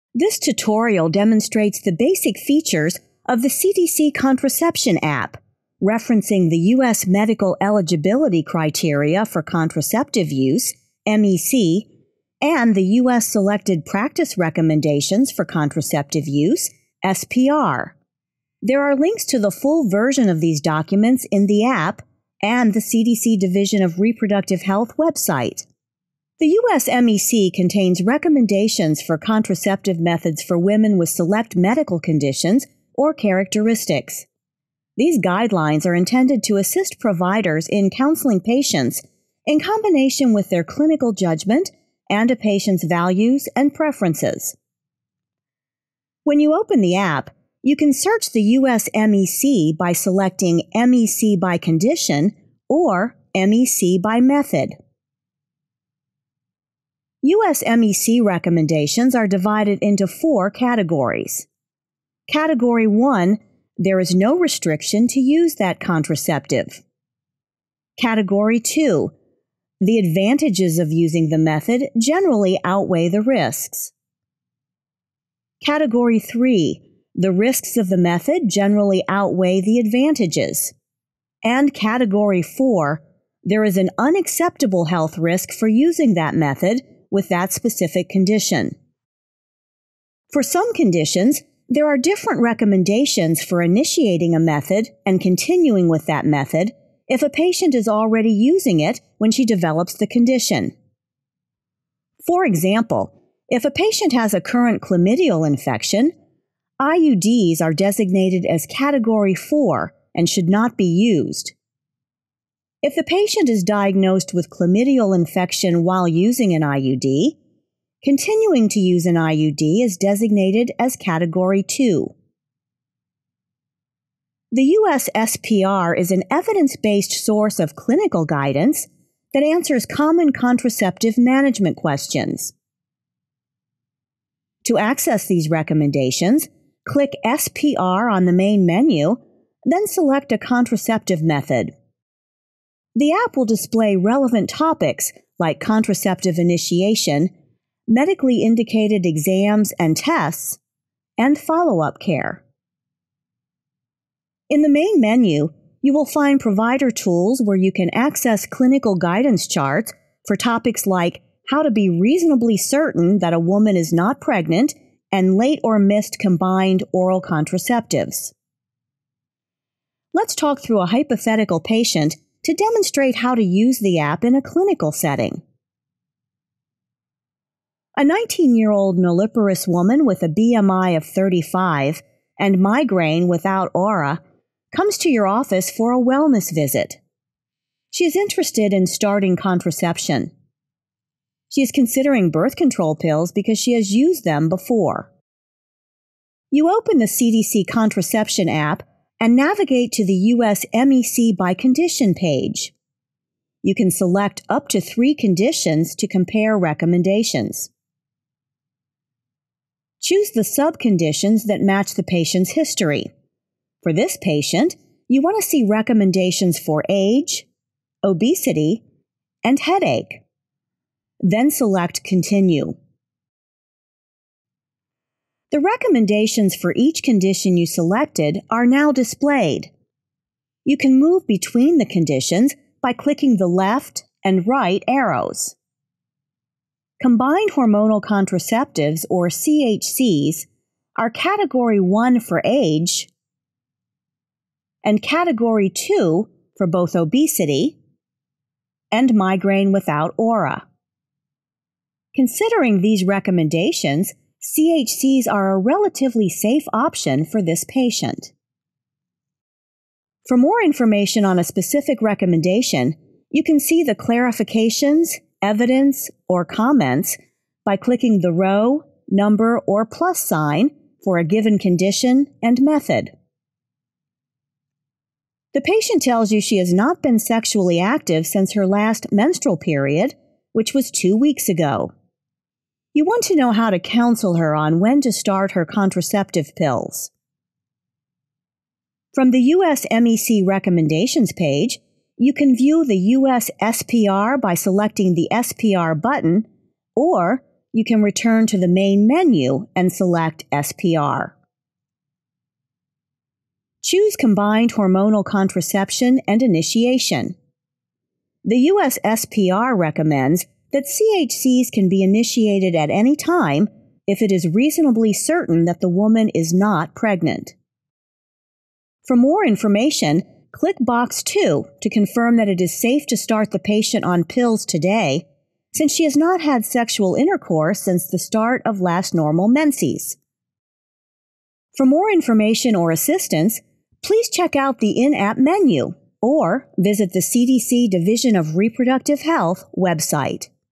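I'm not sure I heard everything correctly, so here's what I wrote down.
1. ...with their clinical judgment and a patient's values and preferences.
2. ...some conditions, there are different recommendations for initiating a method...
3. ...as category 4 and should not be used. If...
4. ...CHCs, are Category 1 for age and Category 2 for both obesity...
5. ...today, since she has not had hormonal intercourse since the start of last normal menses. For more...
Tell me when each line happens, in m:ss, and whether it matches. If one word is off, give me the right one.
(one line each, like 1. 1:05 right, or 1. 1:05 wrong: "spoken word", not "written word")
1. 0:40 right
2. 1:30 right
3. 1:48 right
4. 3:59 right
5. 5:24 wrong: "sexual", not "hormonal".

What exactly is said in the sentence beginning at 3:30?
Choose the subconditions that match the patient's history.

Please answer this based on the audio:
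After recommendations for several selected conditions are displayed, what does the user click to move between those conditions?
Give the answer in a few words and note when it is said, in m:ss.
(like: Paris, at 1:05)
Left and right arrows, at 3:53.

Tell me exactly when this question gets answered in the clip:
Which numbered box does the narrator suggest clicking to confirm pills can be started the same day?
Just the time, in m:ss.
5:20.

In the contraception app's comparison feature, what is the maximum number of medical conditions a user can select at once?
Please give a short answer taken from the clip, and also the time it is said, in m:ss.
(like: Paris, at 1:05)
3, at 3:24.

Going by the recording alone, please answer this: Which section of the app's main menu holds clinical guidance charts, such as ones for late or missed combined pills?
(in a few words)
Provider tools.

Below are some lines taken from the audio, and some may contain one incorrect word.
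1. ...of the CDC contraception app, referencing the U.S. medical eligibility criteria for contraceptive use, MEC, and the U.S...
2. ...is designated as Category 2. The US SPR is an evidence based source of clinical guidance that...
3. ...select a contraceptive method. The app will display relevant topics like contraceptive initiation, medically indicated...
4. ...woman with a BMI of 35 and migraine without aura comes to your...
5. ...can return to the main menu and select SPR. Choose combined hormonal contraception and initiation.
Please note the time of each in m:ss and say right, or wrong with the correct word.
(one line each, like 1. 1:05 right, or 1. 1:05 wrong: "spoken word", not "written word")
1. 0:03 right
2. 1:59 right
3. 2:19 right
4. 2:59 right
5. 4:57 right.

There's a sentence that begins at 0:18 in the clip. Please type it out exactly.
There are links to the full version of these documents in the app and the CDC Division of Reproductive Health website.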